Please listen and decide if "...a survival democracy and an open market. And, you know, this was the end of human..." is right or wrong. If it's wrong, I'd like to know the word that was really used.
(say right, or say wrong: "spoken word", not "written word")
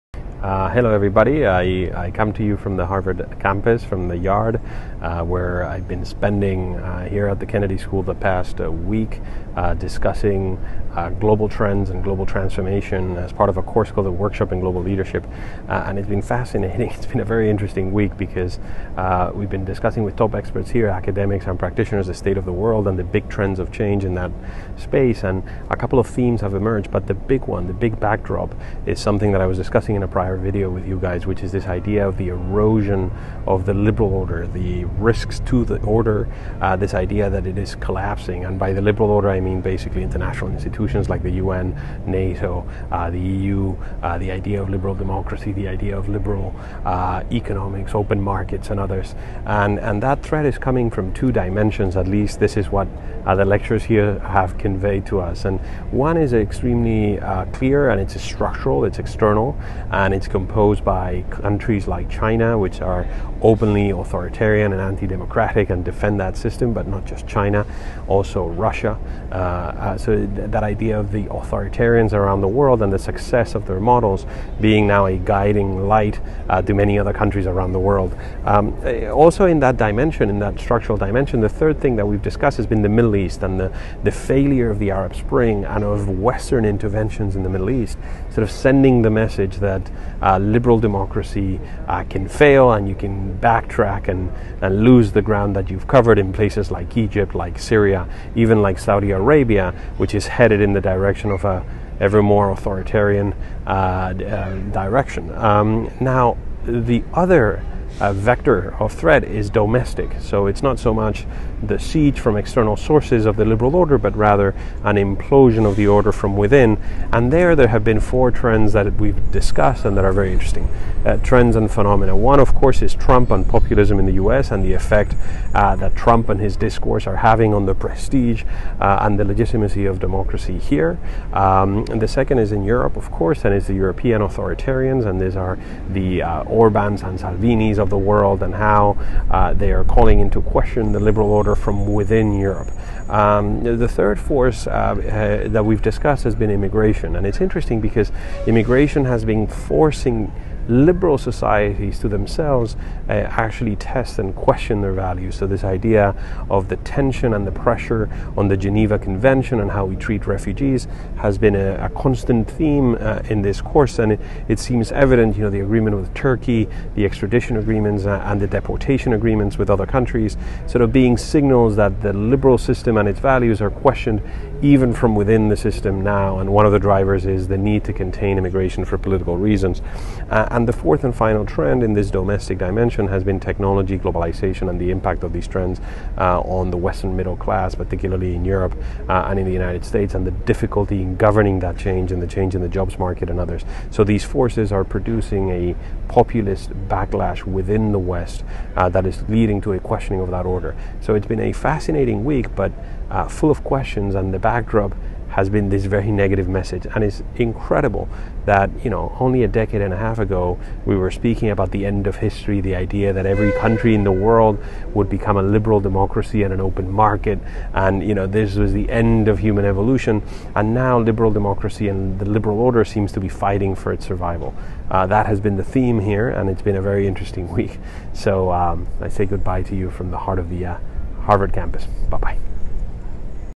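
wrong: "liberal", not "survival".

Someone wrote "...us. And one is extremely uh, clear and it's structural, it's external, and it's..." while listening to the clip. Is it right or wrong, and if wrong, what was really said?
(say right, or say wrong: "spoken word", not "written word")
right.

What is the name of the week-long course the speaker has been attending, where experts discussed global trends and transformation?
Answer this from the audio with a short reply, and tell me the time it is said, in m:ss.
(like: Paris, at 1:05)
Workshop in Global Leadership, at 0:14.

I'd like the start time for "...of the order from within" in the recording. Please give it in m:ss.
1:55.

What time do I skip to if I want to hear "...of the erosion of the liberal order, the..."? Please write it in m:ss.
0:32.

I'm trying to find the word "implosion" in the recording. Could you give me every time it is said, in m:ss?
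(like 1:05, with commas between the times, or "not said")
1:54.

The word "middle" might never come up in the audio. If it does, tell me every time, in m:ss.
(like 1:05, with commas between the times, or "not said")
1:22, 1:27, 3:07.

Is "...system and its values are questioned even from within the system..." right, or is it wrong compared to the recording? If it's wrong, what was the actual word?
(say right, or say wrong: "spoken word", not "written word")
right.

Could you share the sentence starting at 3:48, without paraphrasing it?
So um, I say goodbye to you from the heart of the uh, Harvard campus.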